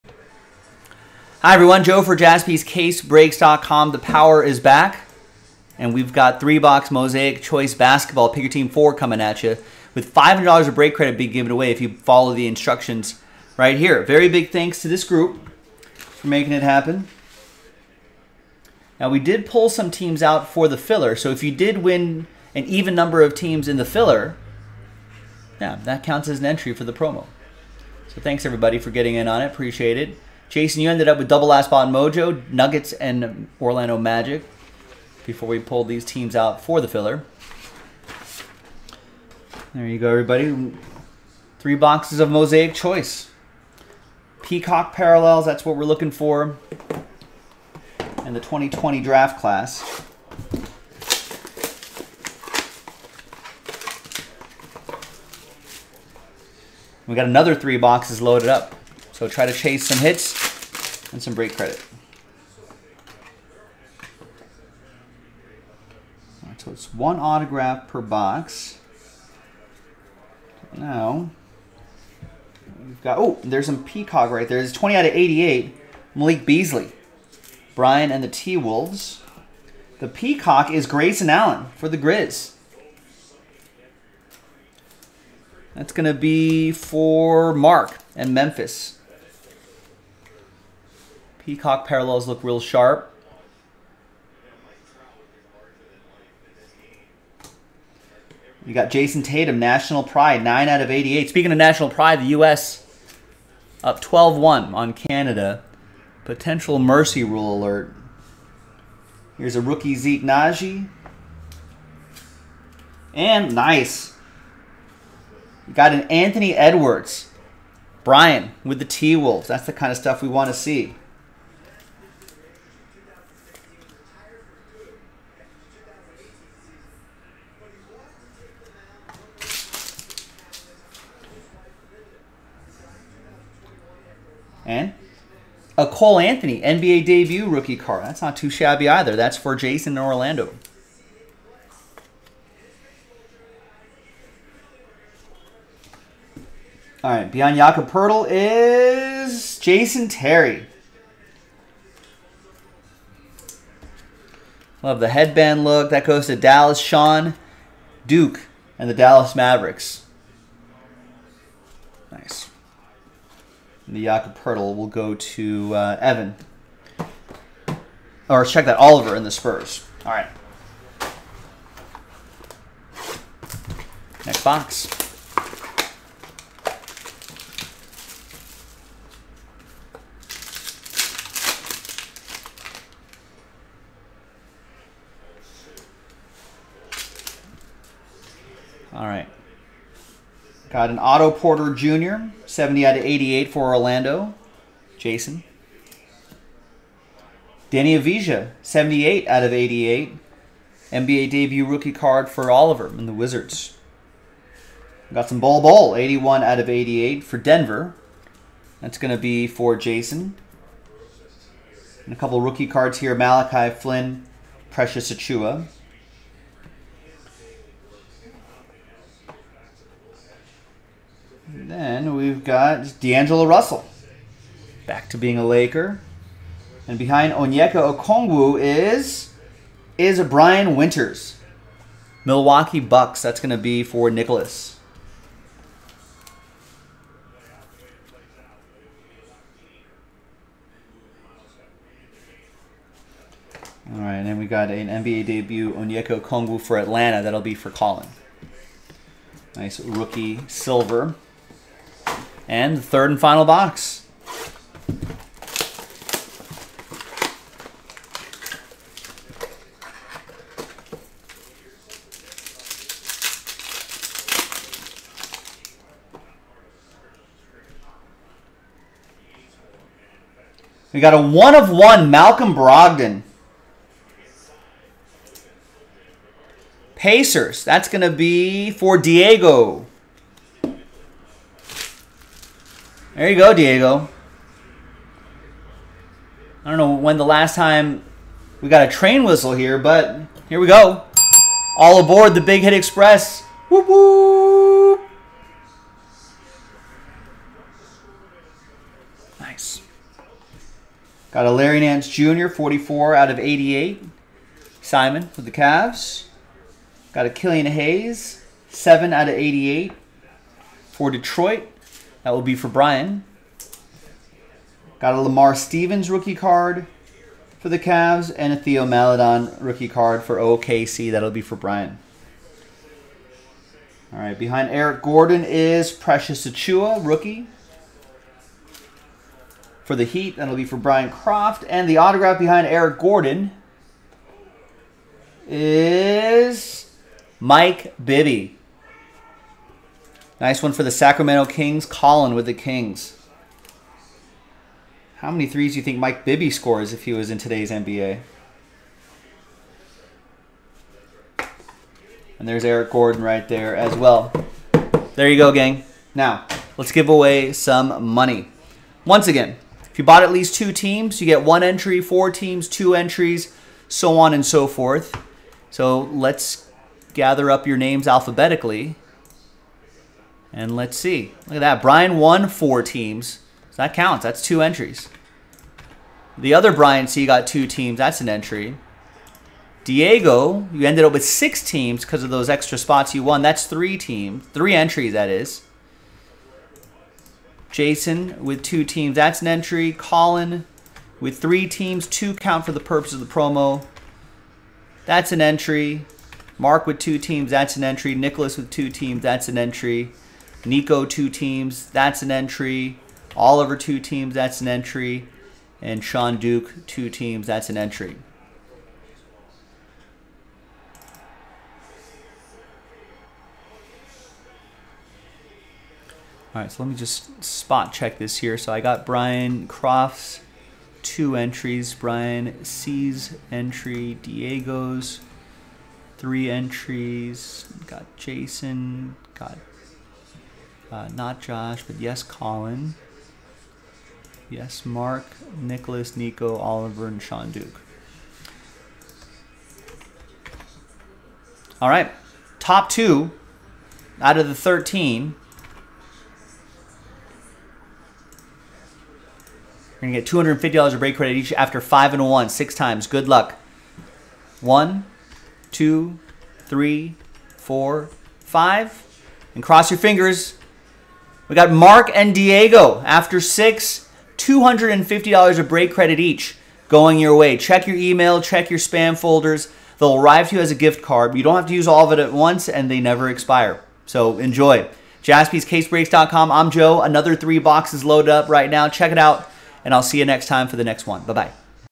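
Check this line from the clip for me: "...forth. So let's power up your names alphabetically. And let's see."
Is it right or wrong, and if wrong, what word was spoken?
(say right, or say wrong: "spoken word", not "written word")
wrong: "gather", not "power".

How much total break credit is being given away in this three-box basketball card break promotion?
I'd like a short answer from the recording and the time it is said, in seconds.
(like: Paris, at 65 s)
$500, at 10 s.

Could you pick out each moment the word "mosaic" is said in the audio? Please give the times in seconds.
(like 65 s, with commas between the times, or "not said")
6 s, 42 s.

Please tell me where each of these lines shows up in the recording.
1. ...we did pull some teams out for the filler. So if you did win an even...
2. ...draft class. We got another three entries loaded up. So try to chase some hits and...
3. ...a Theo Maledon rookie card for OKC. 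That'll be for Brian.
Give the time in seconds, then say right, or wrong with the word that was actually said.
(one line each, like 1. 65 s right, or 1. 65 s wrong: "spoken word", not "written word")
1. 19 s right
2. 48 s wrong: "boxes", not "entries"
3. 318 s right.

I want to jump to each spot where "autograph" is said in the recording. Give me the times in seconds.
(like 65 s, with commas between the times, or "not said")
67 s, 331 s.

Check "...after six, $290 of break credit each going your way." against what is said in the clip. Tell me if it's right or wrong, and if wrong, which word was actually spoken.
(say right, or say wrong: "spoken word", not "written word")
wrong: "250", not "290".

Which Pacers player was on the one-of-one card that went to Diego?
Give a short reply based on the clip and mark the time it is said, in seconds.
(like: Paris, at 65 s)
Malcolm Brogdon, at 272 s.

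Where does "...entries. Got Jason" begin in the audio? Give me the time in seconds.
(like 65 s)
426 s.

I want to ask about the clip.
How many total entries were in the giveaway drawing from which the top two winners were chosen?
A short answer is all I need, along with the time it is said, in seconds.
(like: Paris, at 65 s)
13, at 444 s.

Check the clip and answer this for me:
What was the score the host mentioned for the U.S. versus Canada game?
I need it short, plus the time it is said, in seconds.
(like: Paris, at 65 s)
12-1, at 104 s.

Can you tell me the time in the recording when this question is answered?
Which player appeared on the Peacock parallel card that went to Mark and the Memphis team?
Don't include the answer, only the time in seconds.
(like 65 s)
80 s.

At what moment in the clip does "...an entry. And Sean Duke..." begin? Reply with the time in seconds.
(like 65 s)
404 s.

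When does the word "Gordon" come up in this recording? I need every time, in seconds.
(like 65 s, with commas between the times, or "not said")
325 s, 332 s, 352 s.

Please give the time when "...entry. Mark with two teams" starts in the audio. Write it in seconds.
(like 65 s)
395 s.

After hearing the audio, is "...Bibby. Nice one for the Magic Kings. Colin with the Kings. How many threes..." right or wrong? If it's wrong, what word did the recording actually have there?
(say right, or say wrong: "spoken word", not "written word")
wrong: "Sacramento", not "Magic".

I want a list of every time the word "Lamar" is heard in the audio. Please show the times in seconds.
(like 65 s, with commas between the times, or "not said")
315 s.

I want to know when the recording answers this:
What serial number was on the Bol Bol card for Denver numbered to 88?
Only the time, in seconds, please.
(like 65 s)
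205 s.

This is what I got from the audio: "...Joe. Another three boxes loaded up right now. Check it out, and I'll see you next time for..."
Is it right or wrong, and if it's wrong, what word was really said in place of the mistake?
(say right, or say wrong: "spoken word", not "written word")
right.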